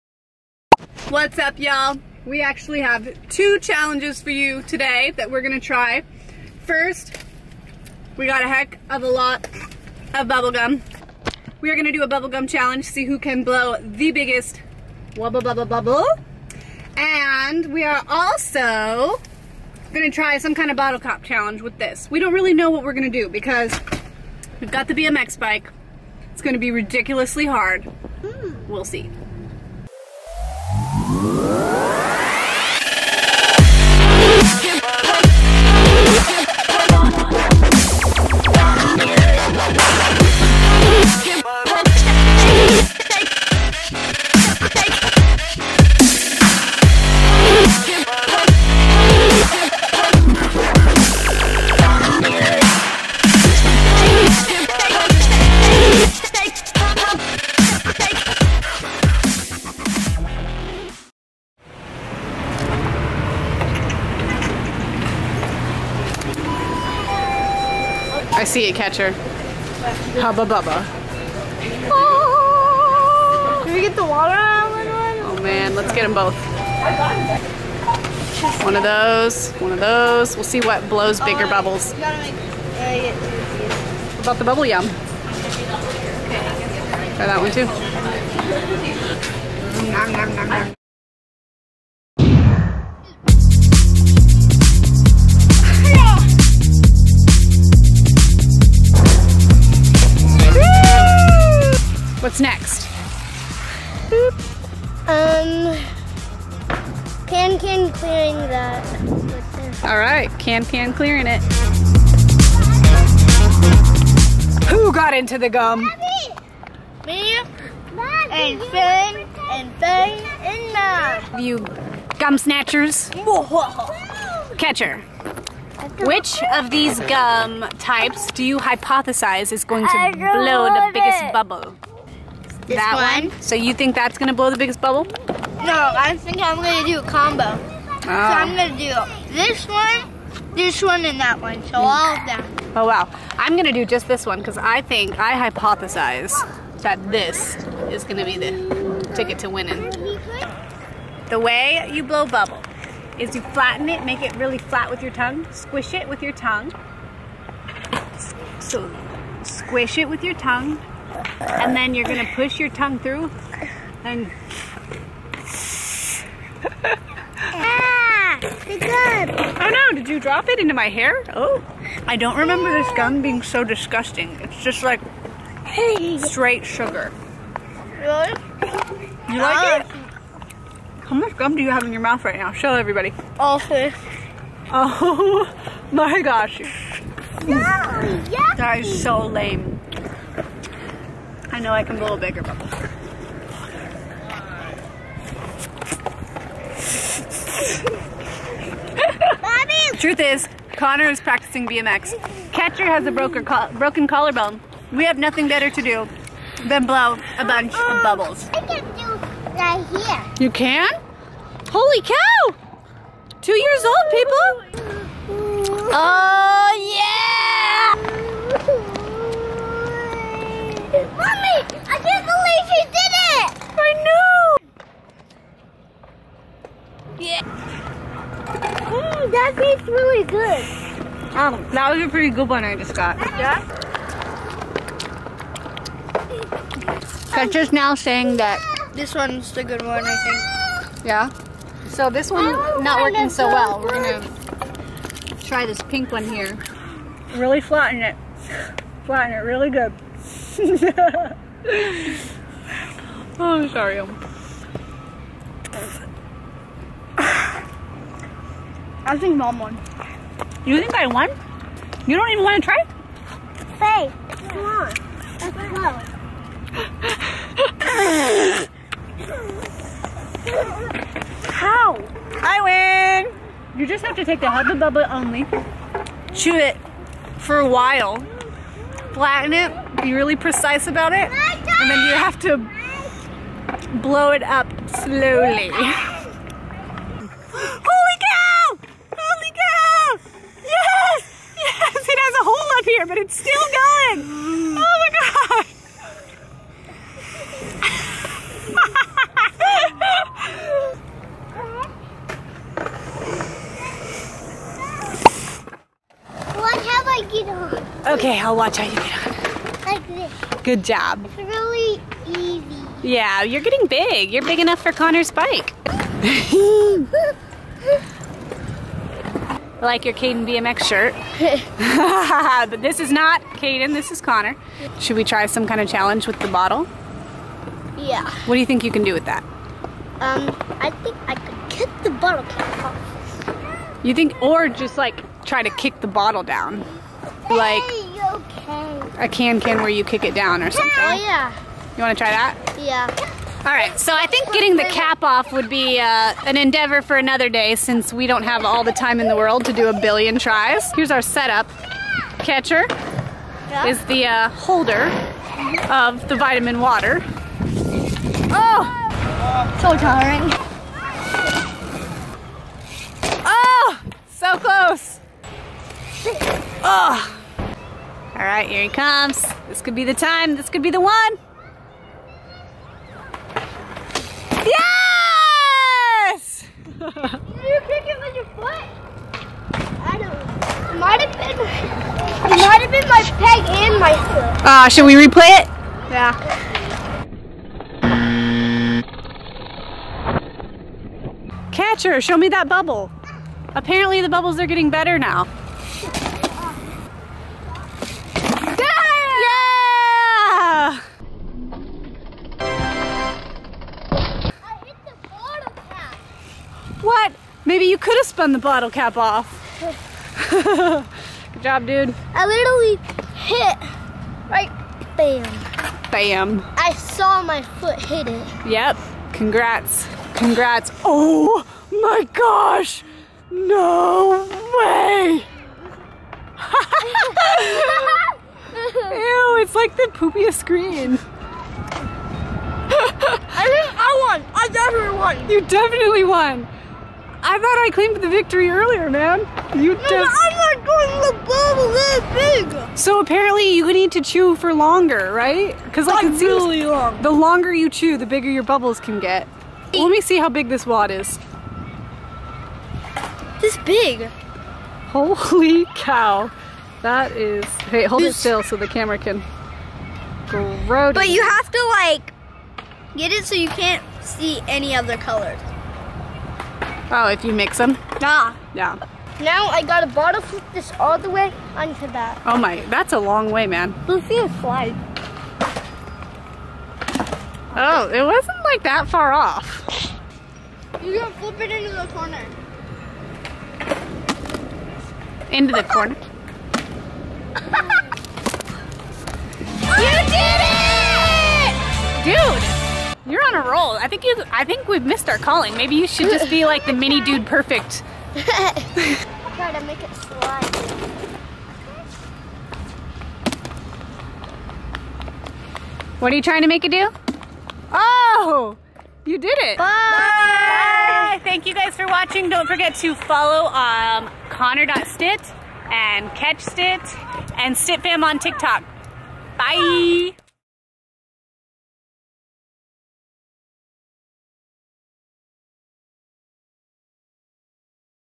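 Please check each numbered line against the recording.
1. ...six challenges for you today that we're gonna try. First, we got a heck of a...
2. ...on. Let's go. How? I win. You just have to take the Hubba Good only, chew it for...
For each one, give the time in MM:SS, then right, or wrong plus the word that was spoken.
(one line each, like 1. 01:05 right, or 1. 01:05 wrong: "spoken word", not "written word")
1. 00:03 wrong: "two", not "six"
2. 04:24 wrong: "Bubba", not "Good".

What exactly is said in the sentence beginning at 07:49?
Now I gotta bottle flip this all the way onto that.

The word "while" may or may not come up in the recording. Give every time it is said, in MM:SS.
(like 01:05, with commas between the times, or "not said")
04:37.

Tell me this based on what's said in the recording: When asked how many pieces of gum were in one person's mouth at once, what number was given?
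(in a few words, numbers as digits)
3.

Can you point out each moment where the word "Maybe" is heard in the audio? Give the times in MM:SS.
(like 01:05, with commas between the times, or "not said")
08:15.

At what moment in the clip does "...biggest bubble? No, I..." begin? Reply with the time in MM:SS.
02:14.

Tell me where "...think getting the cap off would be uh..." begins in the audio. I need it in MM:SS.
05:44.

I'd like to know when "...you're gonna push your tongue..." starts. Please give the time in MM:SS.
02:41.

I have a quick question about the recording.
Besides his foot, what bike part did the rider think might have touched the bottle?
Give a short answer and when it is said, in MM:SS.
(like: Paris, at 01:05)
Peg, at 06:23.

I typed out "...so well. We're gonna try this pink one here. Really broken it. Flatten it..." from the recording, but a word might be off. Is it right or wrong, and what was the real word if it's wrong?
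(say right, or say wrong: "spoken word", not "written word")
wrong: "flatten", not "broken".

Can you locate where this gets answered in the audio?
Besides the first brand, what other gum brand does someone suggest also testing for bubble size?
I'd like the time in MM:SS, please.
01:24.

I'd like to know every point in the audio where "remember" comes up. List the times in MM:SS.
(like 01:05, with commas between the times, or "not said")
02:52.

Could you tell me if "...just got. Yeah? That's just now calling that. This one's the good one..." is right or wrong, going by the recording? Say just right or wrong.
wrong.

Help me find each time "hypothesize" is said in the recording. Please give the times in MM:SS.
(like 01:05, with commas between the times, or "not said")
02:08, 02:25.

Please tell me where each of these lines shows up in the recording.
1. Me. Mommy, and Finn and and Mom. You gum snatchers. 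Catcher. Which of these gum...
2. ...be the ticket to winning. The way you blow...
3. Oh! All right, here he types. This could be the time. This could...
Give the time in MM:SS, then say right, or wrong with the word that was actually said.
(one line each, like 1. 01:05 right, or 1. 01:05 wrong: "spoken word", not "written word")
1. 01:57 right
2. 02:28 right
3. 06:06 wrong: "comes", not "types".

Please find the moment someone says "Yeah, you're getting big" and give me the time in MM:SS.
05:13.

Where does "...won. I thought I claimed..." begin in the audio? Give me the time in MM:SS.
07:16.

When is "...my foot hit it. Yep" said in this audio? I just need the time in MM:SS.
06:57.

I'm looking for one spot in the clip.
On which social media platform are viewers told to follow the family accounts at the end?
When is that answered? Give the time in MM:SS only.
08:38.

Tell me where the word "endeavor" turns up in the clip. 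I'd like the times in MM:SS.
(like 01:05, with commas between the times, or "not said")
05:46.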